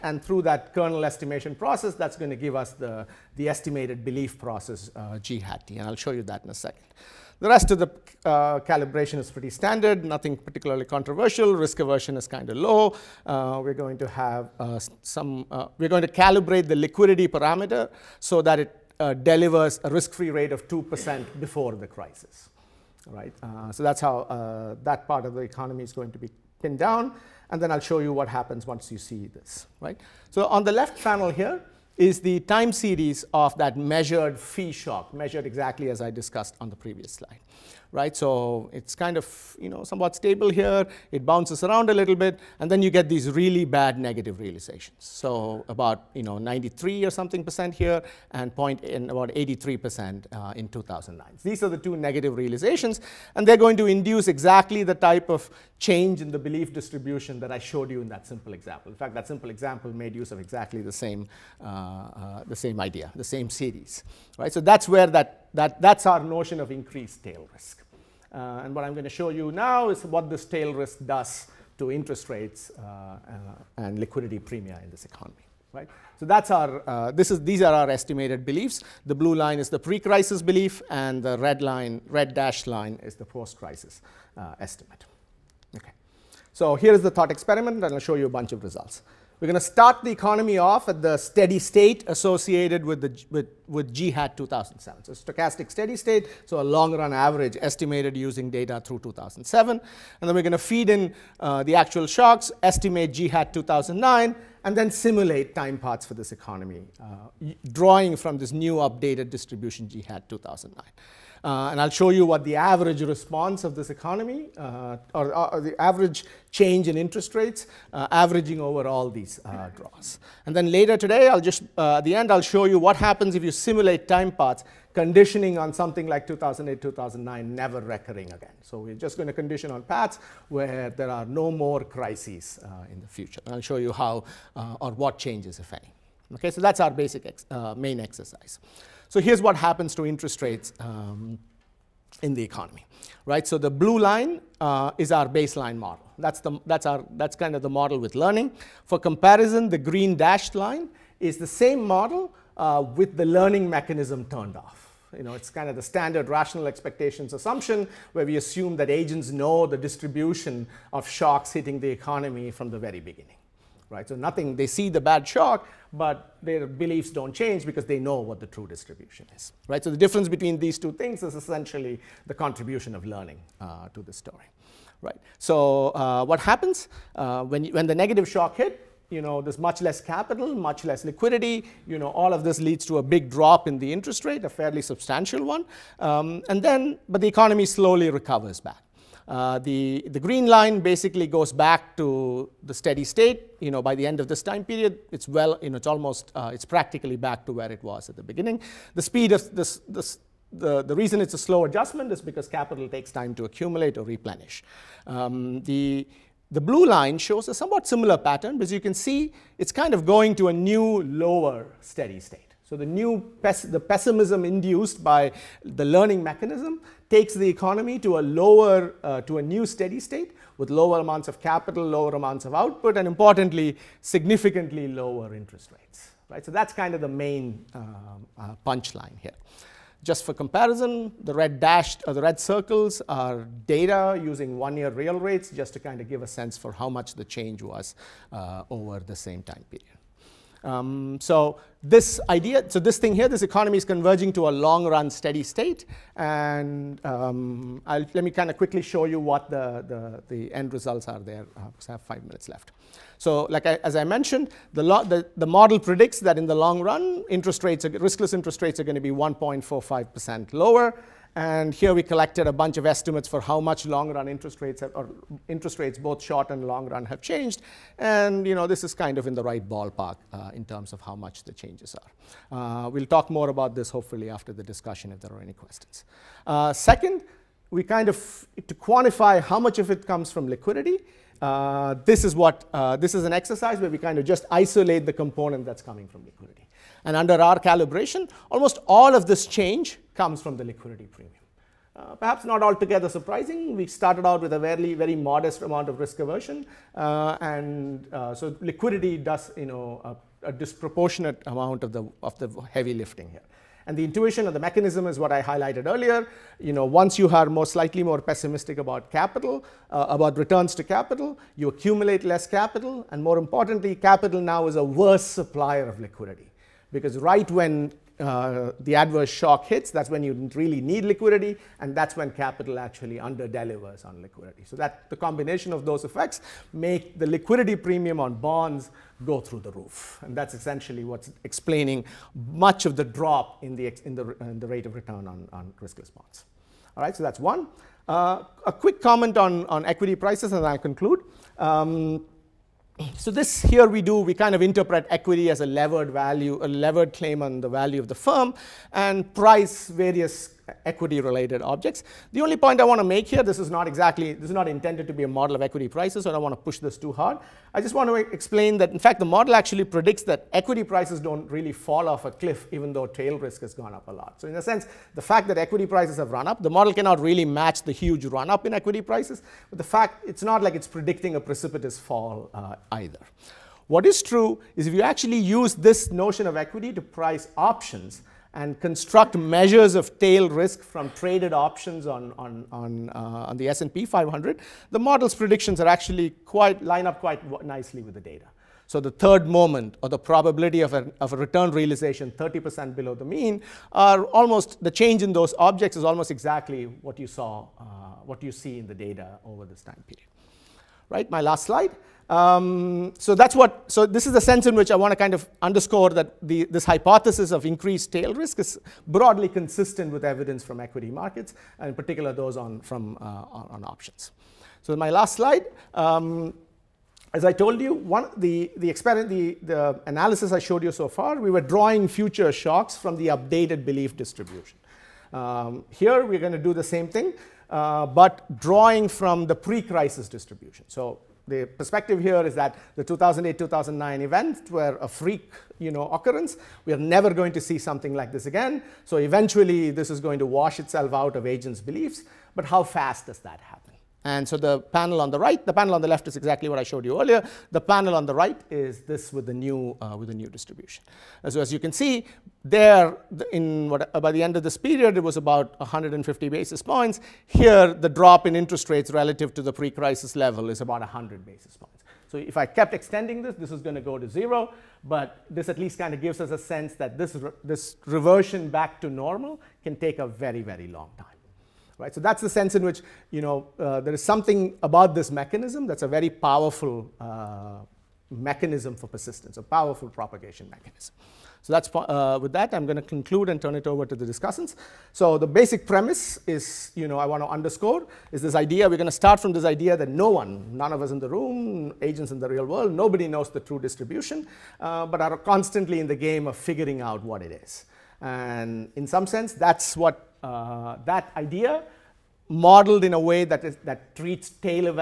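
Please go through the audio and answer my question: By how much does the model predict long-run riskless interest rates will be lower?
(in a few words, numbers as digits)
1.45%.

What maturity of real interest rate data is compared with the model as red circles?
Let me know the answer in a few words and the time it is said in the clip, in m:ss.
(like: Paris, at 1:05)
one-year real rates, at 3:54.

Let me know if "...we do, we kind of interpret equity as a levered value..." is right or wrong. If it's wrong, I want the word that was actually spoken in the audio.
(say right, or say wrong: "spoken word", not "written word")
right.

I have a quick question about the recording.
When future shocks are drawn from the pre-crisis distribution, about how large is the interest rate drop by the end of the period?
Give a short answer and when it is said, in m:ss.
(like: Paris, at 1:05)
100 basis points, at 7:40.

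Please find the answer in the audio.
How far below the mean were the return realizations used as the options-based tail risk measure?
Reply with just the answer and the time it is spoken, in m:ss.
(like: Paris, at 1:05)
30%, at 6:32.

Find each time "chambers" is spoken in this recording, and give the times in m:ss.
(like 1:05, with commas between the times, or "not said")
not said.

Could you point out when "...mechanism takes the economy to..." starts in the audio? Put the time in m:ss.
3:36.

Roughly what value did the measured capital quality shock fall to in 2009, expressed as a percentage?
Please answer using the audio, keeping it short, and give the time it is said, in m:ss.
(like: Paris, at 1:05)
83 percent, at 0:49.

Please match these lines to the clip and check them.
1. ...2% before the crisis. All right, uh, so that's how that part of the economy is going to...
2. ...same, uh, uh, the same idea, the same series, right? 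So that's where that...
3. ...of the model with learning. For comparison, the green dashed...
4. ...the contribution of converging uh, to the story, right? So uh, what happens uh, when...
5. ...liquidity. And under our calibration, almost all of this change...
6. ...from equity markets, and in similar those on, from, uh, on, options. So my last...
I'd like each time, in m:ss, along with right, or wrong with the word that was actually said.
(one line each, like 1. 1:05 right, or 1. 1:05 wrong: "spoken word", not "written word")
1. 0:20 right
2. 1:00 right
3. 2:27 right
4. 2:52 wrong: "learning", not "converging"
5. 4:46 right
6. 6:50 wrong: "particular", not "similar".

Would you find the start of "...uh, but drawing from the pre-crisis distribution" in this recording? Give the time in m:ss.
7:07.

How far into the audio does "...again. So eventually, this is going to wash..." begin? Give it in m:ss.
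7:18.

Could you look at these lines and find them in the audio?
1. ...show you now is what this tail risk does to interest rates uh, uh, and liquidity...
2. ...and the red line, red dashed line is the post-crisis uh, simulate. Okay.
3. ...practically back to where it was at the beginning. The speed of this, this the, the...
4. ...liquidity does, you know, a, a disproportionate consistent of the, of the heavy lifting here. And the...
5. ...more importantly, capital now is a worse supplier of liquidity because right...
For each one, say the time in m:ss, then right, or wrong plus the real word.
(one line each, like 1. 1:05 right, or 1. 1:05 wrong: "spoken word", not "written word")
1. 1:09 right
2. 1:20 wrong: "estimate", not "simulate"
3. 3:16 right
4. 4:58 wrong: "amount", not "consistent"
5. 5:13 right.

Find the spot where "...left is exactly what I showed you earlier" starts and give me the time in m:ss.
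7:26.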